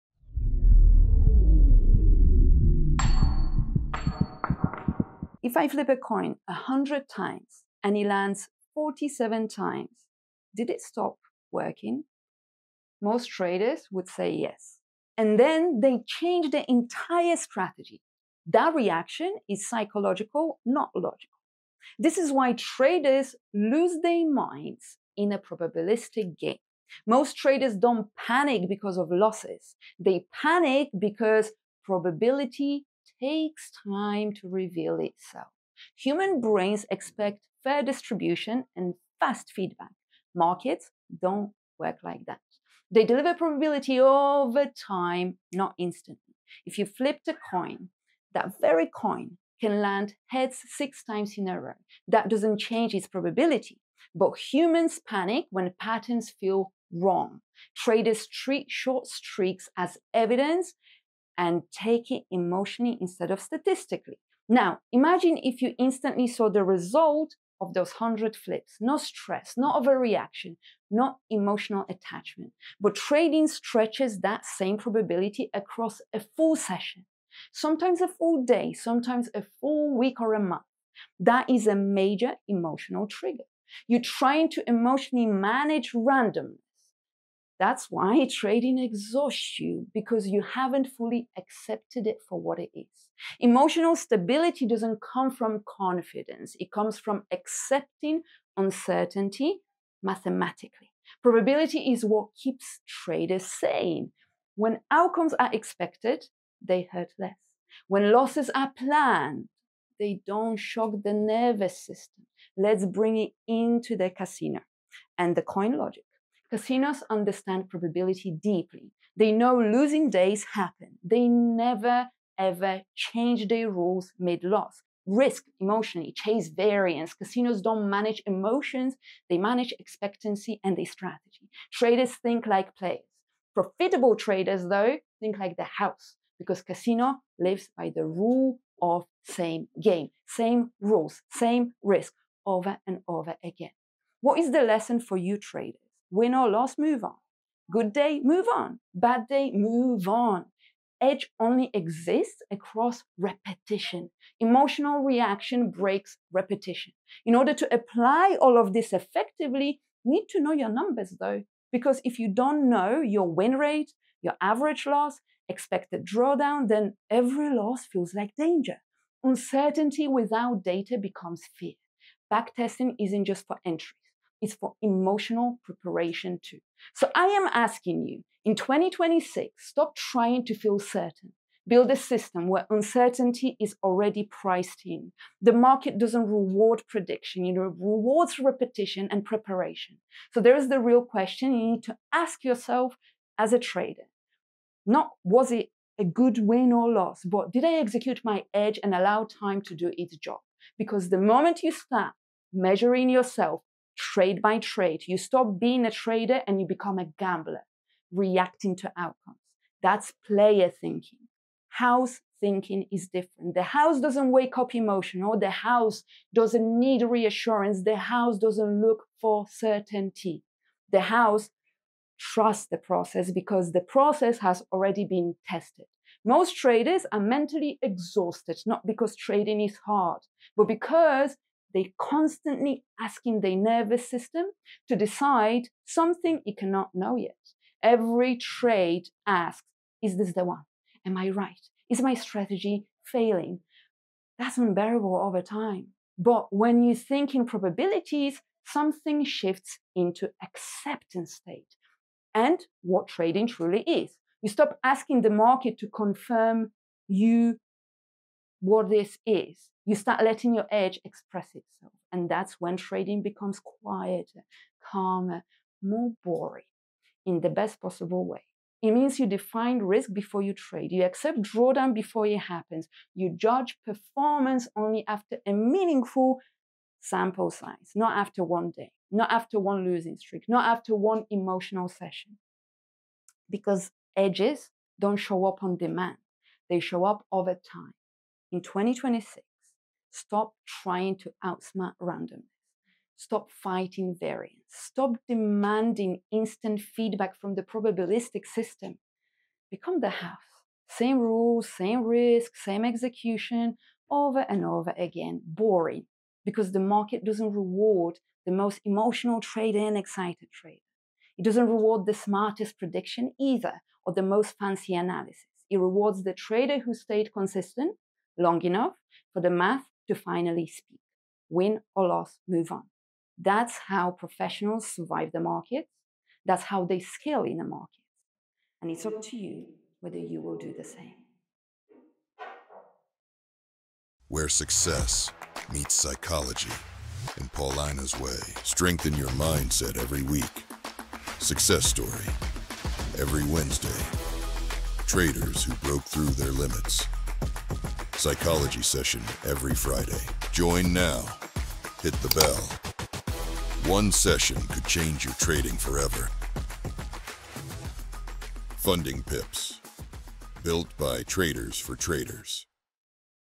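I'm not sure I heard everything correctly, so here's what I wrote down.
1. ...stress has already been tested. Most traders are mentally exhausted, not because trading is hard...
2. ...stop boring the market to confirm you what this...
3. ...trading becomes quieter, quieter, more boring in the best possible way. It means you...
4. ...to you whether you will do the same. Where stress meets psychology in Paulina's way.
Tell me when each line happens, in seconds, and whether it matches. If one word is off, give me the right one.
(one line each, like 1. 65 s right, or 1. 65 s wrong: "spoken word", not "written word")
1. 223 s wrong: "process", not "stress"
2. 254 s wrong: "asking", not "boring"
3. 262 s wrong: "calmer", not "quieter"
4. 329 s wrong: "success", not "stress".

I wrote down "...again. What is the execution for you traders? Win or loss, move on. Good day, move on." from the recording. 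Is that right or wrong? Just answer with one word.
wrong.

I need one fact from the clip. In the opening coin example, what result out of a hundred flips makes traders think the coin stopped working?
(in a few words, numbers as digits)
47.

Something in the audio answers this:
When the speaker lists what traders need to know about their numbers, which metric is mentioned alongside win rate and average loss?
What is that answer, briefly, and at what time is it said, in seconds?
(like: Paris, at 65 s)
Expected drawdown, at 165 s.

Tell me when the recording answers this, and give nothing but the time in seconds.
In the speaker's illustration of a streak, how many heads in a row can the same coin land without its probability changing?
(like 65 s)
50 s.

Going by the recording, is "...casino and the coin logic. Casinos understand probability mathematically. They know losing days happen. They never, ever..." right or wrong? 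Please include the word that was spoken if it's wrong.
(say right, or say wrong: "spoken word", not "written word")
wrong: "deeply", not "mathematically".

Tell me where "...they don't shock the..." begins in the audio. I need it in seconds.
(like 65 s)
109 s.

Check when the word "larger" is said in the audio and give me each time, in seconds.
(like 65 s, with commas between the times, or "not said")
not said.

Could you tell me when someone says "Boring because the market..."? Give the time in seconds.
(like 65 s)
305 s.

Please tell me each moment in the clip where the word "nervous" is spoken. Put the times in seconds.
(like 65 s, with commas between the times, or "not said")
111 s, 233 s.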